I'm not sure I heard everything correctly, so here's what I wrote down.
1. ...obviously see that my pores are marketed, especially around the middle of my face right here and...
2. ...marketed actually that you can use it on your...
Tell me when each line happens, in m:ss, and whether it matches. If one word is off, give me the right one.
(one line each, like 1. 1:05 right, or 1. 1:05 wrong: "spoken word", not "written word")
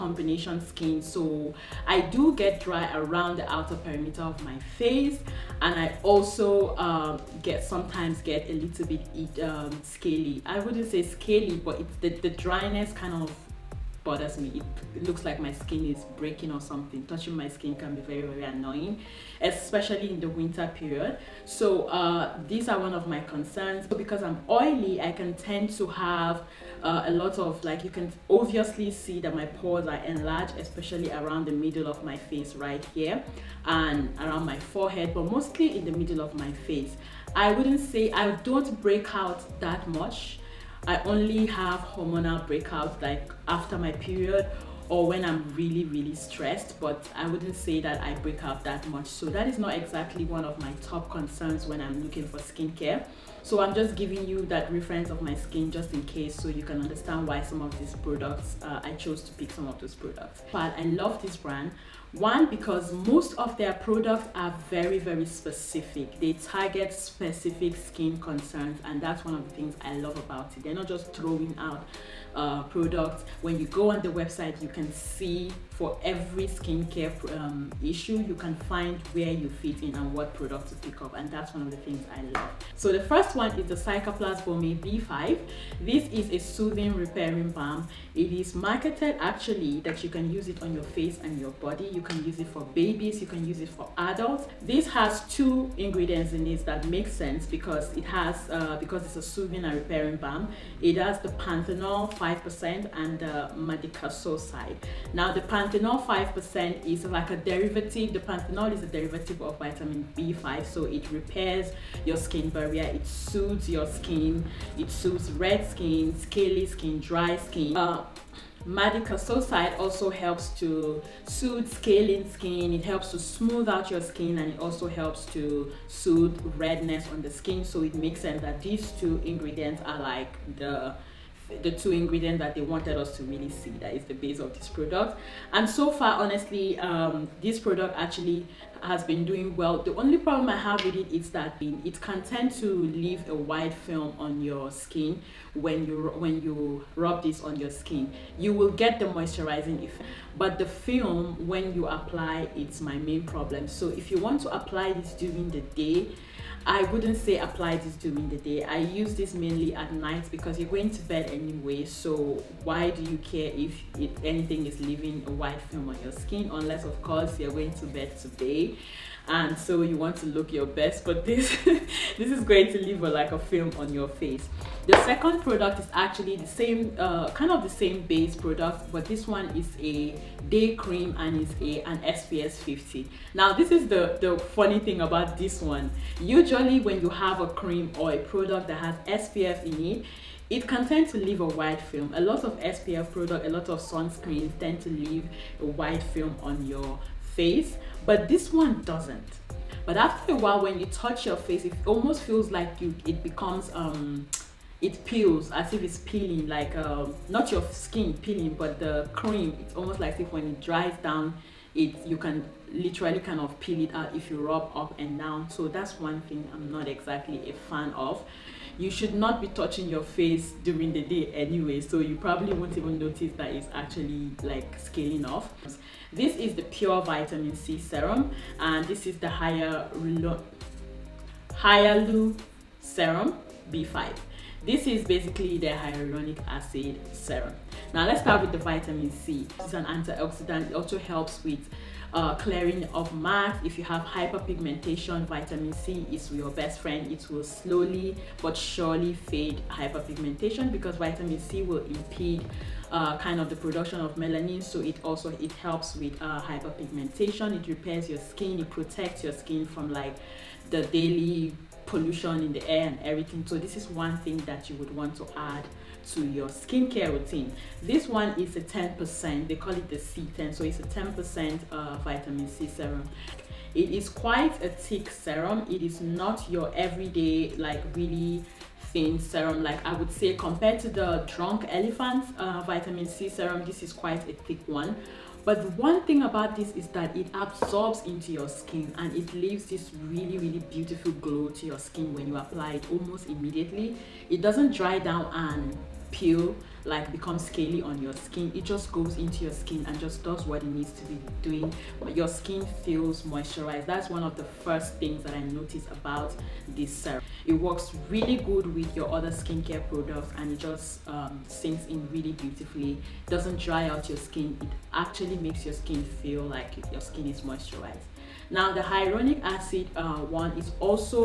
1. 0:28 wrong: "enlarged", not "marketed"
2. 1:28 right.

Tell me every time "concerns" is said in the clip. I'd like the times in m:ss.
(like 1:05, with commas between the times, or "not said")
0:23, 0:51, 1:08.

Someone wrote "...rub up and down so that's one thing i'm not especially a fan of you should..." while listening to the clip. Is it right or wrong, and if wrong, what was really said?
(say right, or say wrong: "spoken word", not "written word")
wrong: "exactly", not "especially".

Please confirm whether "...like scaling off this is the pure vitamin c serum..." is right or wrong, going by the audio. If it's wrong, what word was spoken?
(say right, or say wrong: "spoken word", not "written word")
right.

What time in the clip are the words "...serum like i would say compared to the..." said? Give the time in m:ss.
4:39.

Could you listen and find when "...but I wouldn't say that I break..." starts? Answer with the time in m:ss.
0:46.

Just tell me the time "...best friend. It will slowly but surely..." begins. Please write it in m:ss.
4:06.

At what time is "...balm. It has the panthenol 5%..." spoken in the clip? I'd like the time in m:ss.
1:40.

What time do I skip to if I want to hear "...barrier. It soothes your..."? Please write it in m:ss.
1:52.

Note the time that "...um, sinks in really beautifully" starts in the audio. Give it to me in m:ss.
5:11.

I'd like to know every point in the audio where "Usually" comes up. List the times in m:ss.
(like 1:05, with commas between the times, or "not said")
3:06.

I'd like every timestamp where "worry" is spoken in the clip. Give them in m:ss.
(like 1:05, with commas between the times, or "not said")
not said.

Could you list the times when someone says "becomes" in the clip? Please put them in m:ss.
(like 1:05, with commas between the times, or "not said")
3:23, 4:57.